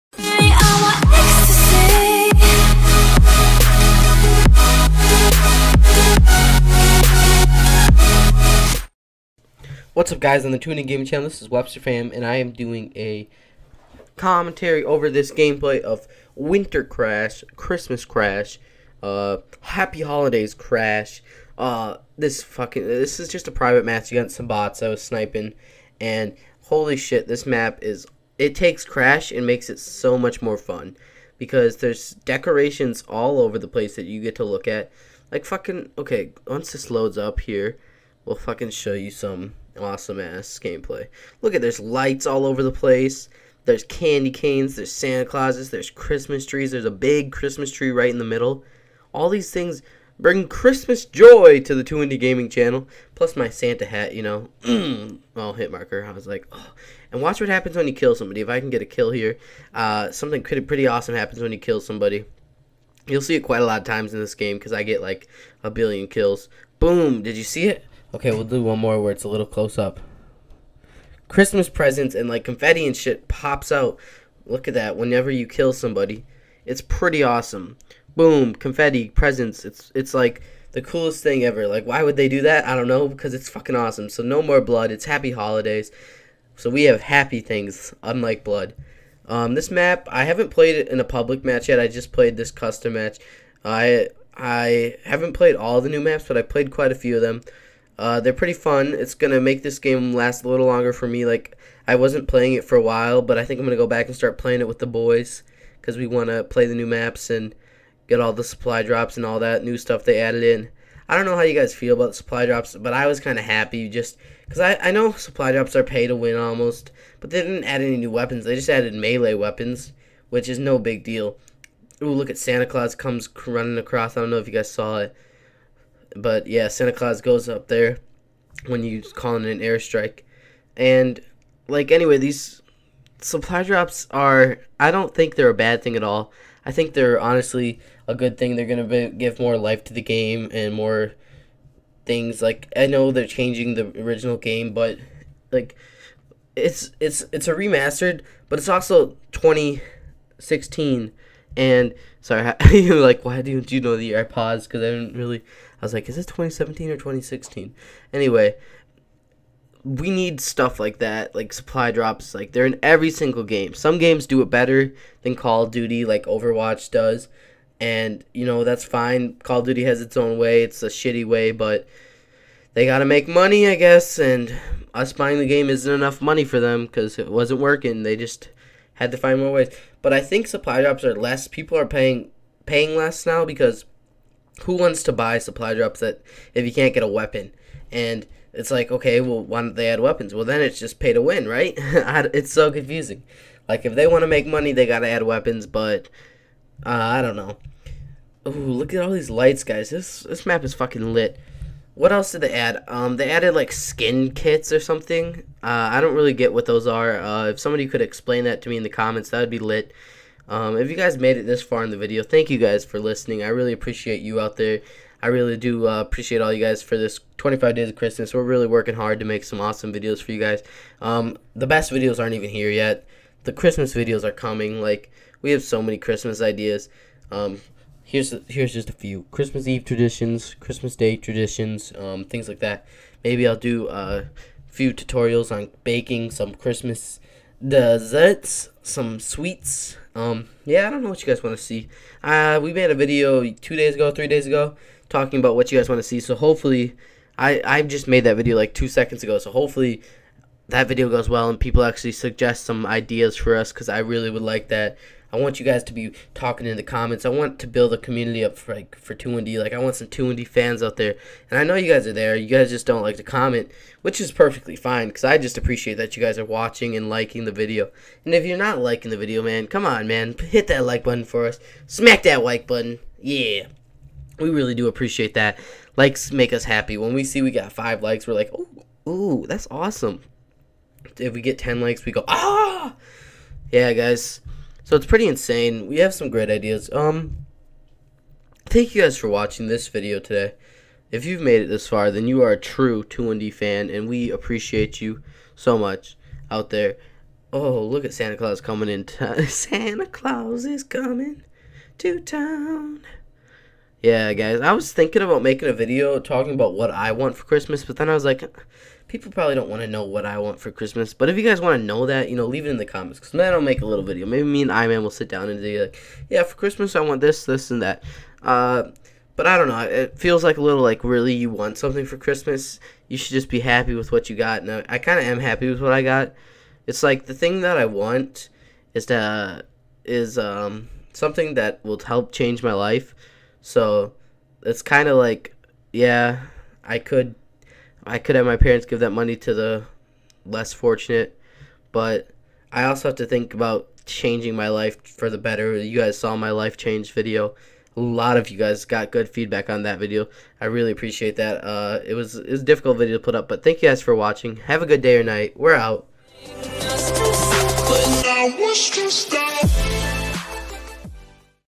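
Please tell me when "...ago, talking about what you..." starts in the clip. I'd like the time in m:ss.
4:04.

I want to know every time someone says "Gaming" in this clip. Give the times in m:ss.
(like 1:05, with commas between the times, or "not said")
0:10, 0:52.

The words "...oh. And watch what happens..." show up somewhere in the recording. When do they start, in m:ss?
0:56.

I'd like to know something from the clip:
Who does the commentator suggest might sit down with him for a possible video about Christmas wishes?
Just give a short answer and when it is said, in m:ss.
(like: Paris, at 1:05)
I-Man, at 5:14.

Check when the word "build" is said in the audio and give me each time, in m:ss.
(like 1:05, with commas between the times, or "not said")
4:17.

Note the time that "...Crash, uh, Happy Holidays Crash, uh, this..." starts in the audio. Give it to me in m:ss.
0:18.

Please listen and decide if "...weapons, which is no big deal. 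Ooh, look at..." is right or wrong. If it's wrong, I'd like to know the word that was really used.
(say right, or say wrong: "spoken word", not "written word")
right.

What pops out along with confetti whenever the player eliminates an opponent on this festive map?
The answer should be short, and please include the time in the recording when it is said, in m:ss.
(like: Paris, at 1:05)
Christmas presents, at 1:11.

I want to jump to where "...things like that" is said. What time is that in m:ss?
3:52.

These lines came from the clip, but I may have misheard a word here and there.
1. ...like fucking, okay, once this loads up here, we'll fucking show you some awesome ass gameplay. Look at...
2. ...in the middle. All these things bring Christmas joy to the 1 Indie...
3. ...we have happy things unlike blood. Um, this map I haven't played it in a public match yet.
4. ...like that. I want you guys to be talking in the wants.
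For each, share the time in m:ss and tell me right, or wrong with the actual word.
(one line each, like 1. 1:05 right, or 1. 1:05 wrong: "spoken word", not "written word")
1. 0:35 right
2. 0:48 wrong: "2", not "1"
3. 1:26 right
4. 4:14 wrong: "comments", not "wants".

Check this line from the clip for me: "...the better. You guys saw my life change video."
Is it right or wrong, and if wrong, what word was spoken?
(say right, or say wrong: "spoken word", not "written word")
right.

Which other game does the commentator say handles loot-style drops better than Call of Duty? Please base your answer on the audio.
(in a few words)
Overwatch.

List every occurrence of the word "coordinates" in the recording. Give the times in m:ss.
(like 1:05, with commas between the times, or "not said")
not said.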